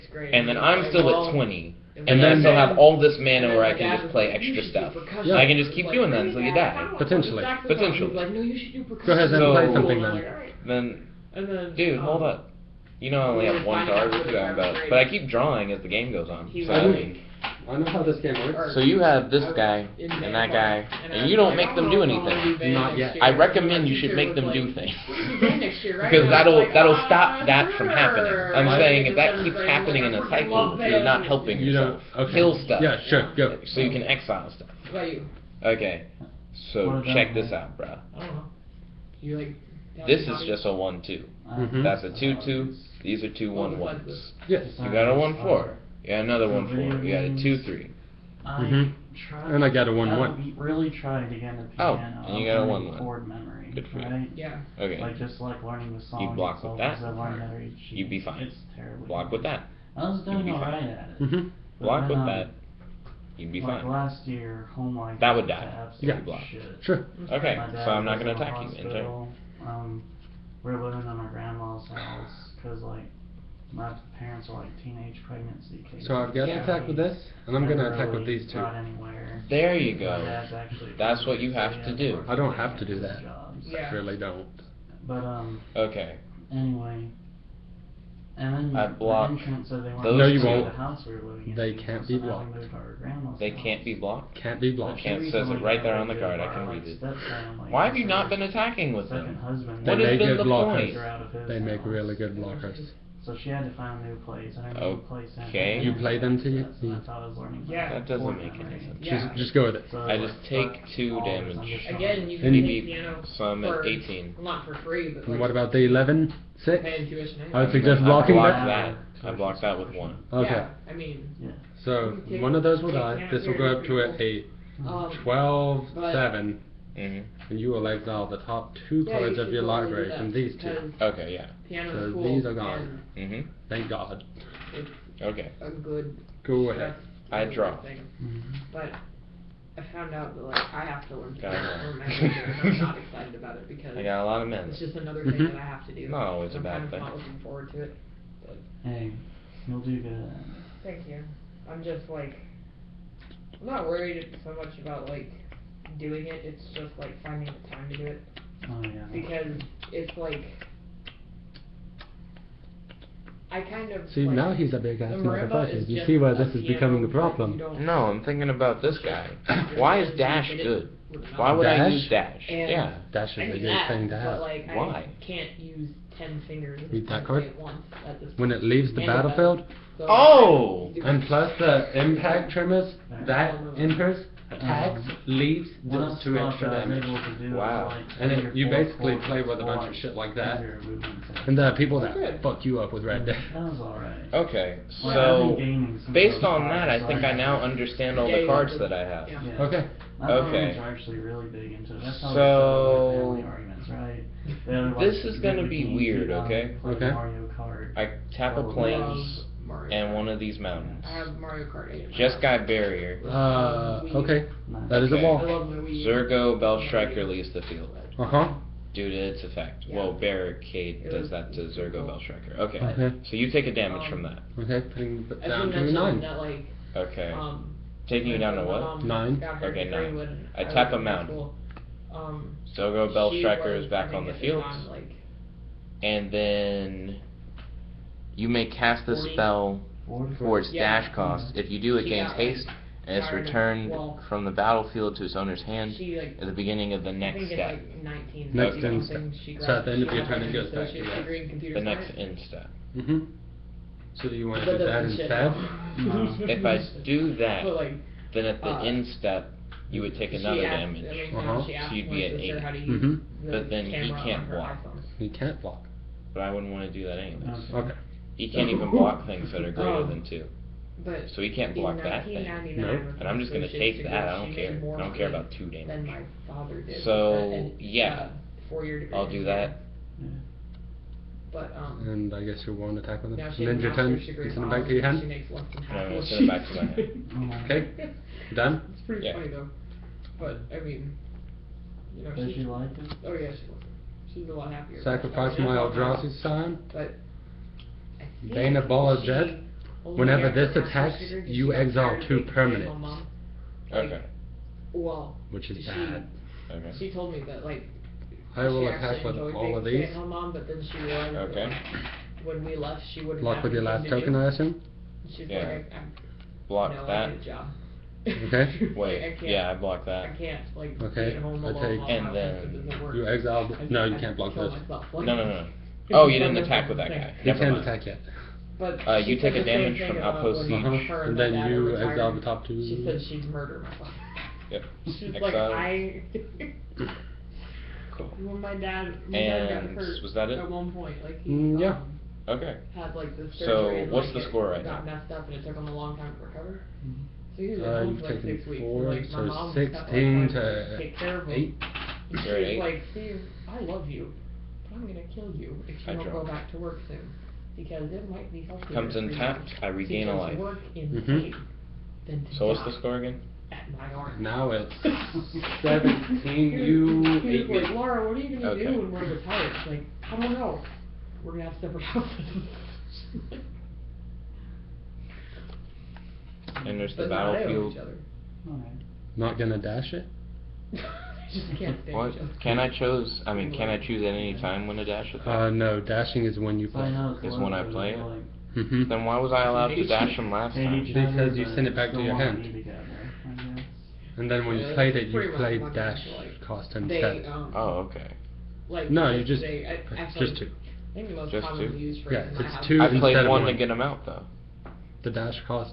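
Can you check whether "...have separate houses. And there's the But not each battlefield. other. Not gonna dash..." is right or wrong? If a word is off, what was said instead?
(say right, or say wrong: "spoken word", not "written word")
right.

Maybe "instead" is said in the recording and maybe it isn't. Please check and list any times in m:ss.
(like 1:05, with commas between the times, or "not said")
4:15, 6:36.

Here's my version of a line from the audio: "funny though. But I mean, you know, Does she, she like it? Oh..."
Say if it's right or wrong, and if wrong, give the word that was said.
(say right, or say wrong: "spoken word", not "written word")
right.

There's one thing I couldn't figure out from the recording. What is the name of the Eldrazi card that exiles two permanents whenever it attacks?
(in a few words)
Bane of Bala Ged.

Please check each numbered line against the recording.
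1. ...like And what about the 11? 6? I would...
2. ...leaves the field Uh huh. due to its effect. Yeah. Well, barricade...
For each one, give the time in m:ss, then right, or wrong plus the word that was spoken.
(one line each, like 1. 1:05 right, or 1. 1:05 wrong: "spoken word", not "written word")
1. 1:55 right
2. 3:37 right.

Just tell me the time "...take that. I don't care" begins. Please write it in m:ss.
4:33.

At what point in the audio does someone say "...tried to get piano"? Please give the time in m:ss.
0:50.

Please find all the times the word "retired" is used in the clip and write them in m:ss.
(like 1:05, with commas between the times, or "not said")
6:09.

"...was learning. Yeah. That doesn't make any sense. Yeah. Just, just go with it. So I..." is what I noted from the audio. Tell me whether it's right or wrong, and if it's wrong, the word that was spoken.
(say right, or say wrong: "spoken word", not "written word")
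right.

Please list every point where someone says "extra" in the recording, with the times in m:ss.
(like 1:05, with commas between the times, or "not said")
0:04, 3:06.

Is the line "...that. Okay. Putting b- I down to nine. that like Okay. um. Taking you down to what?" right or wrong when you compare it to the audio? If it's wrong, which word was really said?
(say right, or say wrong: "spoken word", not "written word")
right.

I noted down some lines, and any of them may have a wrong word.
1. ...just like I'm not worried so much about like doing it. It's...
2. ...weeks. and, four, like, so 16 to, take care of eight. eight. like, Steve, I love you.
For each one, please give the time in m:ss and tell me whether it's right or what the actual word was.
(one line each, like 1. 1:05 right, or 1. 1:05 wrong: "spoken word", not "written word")
1. 2:31 right
2. 5:48 right.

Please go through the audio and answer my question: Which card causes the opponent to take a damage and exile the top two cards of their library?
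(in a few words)
Outpost Siege.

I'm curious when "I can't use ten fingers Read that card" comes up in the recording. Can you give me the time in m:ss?
2:55.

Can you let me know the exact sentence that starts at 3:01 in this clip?
and plus the impact tremors, that enters, tags.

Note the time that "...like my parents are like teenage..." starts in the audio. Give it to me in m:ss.
1:12.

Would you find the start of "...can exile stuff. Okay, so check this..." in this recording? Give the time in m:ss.
0:33.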